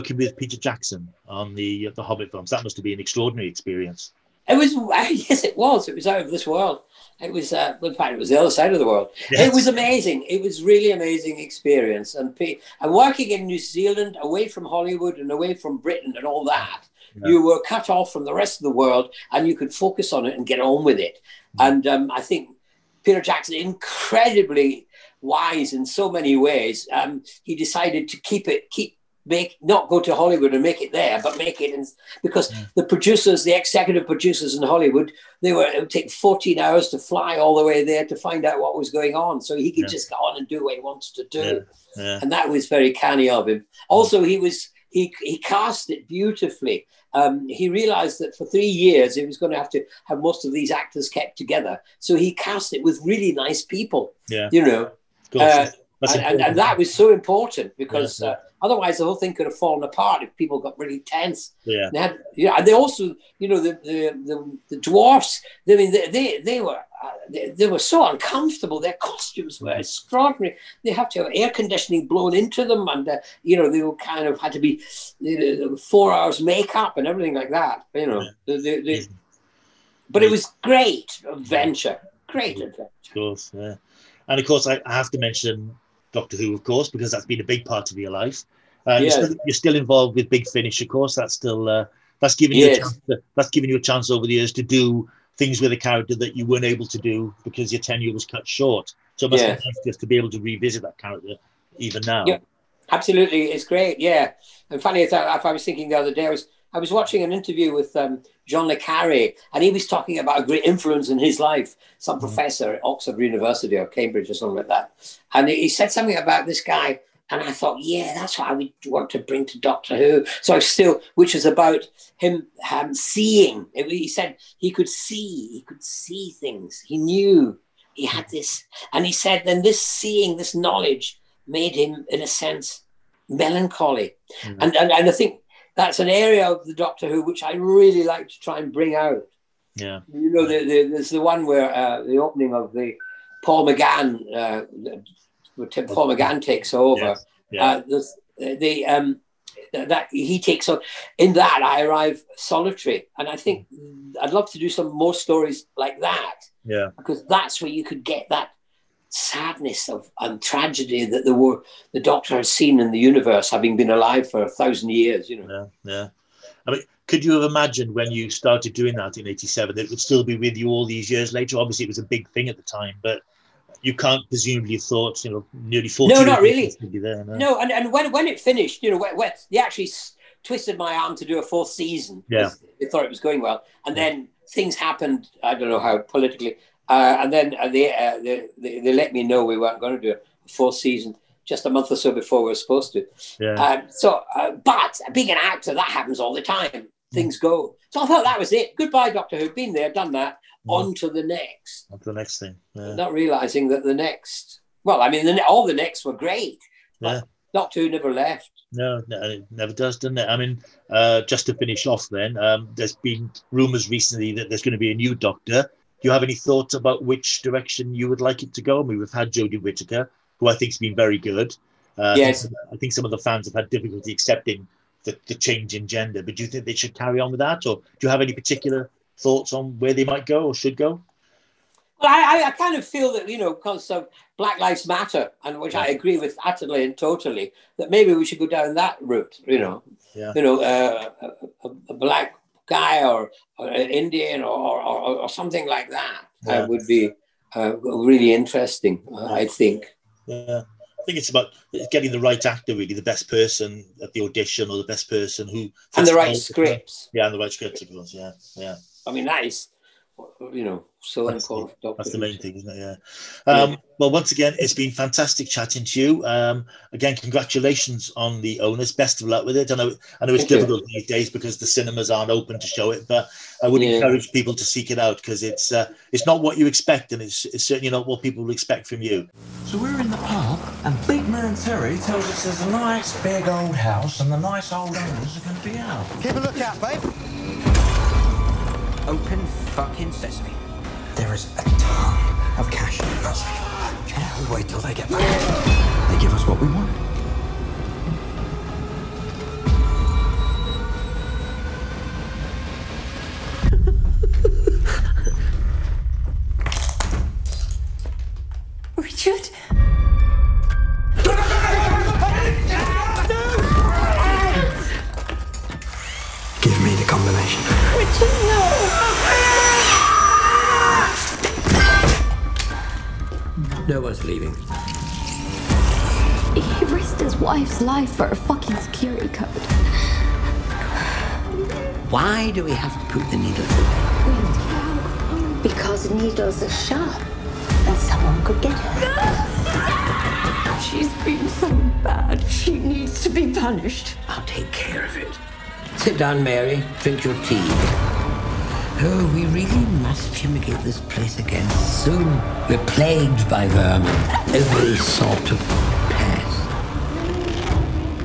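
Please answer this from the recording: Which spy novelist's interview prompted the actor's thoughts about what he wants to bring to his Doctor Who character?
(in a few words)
John Le Carre.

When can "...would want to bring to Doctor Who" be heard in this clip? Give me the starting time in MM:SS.
01:58.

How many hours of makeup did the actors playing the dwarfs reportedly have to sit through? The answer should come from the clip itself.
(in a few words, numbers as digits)
4 hours.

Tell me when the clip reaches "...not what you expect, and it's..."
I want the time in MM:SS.
04:36.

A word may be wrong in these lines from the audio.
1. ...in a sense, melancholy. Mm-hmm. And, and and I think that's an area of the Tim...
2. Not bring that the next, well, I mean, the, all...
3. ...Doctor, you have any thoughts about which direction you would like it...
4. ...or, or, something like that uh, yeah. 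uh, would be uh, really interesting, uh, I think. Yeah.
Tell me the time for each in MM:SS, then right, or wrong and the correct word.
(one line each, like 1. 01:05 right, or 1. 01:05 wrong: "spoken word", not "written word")
1. 02:12 wrong: "Doctor", not "Tim"
2. 03:22 wrong: "realizing", not "bring"
3. 03:35 right
4. 04:04 right.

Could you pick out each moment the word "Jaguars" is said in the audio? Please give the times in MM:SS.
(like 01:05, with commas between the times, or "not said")
not said.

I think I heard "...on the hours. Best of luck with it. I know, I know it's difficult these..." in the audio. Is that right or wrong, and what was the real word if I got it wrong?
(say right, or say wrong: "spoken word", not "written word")
wrong: "owners", not "hours".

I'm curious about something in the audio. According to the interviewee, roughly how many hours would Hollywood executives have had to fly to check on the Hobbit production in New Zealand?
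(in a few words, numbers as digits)
14.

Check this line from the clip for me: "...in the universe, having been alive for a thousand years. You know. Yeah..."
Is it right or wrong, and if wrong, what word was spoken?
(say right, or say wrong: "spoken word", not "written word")
right.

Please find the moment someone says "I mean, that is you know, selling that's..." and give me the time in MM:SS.
04:19.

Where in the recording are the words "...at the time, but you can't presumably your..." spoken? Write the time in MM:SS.
02:52.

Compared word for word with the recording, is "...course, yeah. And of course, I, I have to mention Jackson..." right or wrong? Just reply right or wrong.
wrong.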